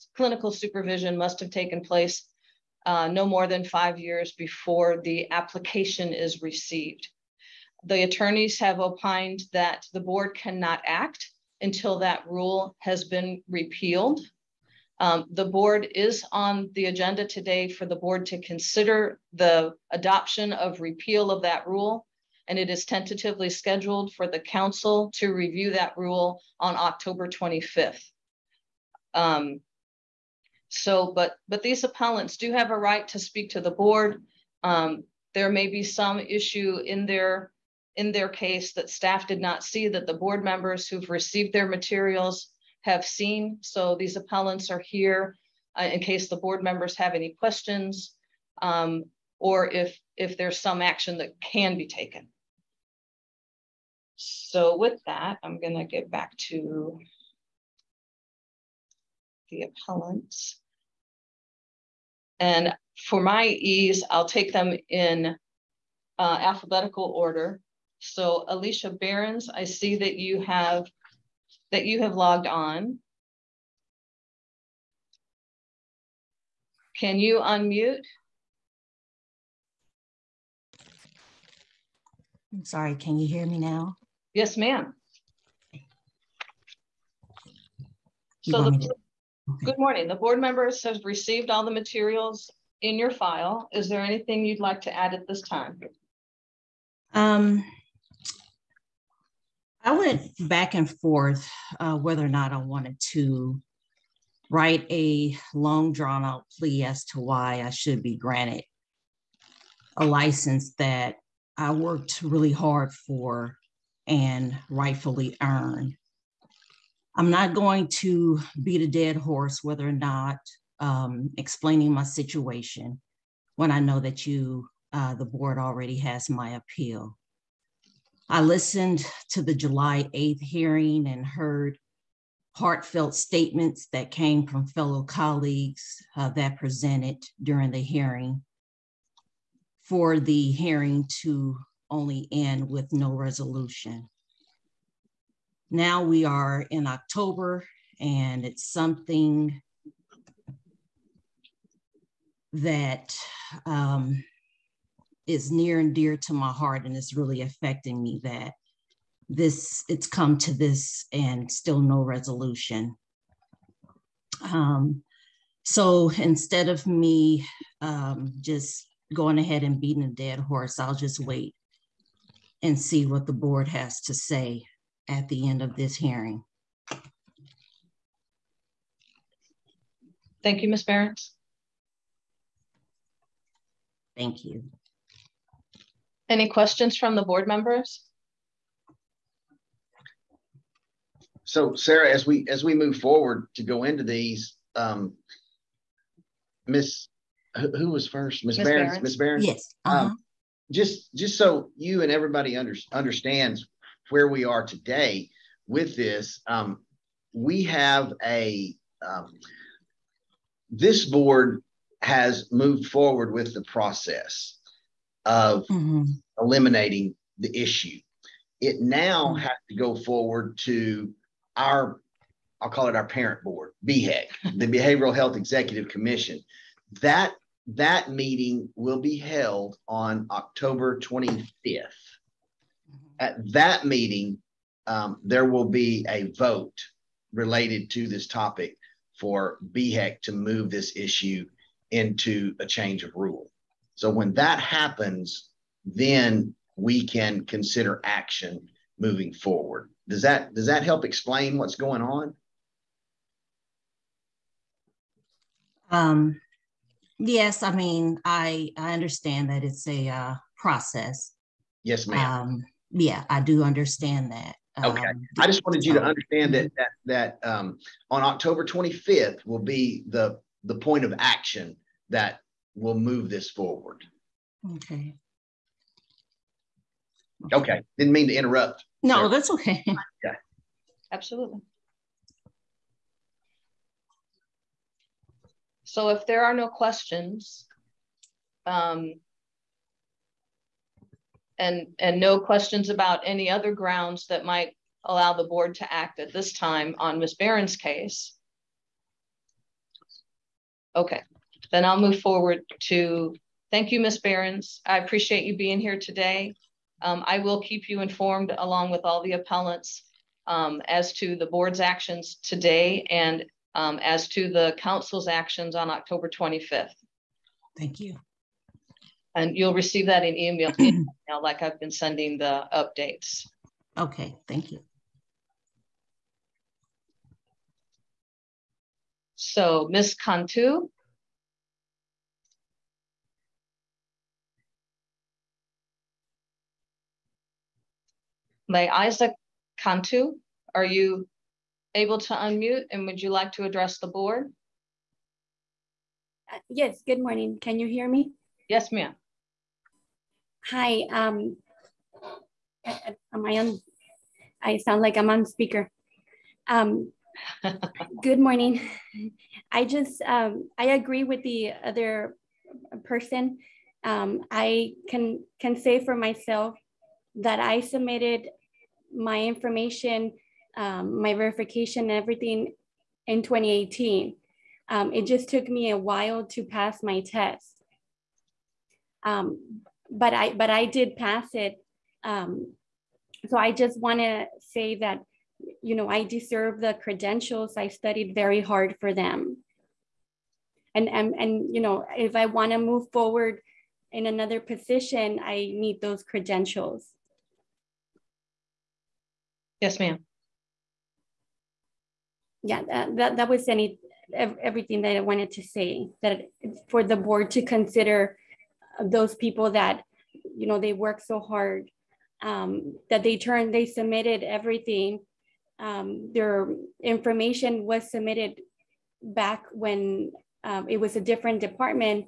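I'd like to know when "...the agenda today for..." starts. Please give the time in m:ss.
0:16.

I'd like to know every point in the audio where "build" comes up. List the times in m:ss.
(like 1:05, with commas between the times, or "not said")
not said.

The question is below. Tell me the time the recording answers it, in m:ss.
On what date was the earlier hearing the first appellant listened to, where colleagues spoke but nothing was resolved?
2:09.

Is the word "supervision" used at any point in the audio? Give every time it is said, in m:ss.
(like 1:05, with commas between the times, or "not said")
0:00.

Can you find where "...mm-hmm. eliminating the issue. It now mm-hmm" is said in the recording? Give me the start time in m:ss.
3:35.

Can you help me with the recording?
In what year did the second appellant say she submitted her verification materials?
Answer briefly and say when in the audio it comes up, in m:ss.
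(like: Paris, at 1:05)
2018, at 6:13.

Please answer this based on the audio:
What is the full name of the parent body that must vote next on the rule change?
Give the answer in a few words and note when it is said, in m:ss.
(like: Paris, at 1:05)
Behavioral Health Executive Commission, at 3:44.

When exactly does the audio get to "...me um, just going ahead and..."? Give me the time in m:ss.
2:46.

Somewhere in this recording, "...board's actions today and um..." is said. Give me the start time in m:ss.
5:11.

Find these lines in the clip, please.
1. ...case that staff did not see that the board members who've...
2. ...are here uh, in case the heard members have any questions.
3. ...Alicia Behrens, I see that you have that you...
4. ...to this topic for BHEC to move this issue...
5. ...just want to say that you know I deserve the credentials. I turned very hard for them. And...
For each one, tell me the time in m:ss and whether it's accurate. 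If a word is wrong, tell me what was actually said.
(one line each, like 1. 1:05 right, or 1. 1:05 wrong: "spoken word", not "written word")
1. 0:38 right
2. 0:44 wrong: "board", not "heard"
3. 1:08 right
4. 3:57 right
5. 6:23 wrong: "studied", not "turned".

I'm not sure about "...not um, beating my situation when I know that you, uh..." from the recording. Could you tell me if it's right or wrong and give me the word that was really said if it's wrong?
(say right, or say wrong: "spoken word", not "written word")
wrong: "explaining", not "beating".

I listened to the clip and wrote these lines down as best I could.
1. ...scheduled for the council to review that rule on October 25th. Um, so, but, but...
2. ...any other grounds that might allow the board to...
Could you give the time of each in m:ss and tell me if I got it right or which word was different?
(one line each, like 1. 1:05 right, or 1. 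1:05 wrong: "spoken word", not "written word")
1. 0:23 right
2. 4:53 right.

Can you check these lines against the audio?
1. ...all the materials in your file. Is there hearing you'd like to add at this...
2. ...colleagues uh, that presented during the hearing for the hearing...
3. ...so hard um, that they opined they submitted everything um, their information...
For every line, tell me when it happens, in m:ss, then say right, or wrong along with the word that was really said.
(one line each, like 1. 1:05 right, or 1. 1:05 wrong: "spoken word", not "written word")
1. 1:31 wrong: "anything", not "hearing"
2. 2:15 right
3. 6:51 wrong: "turned", not "opined".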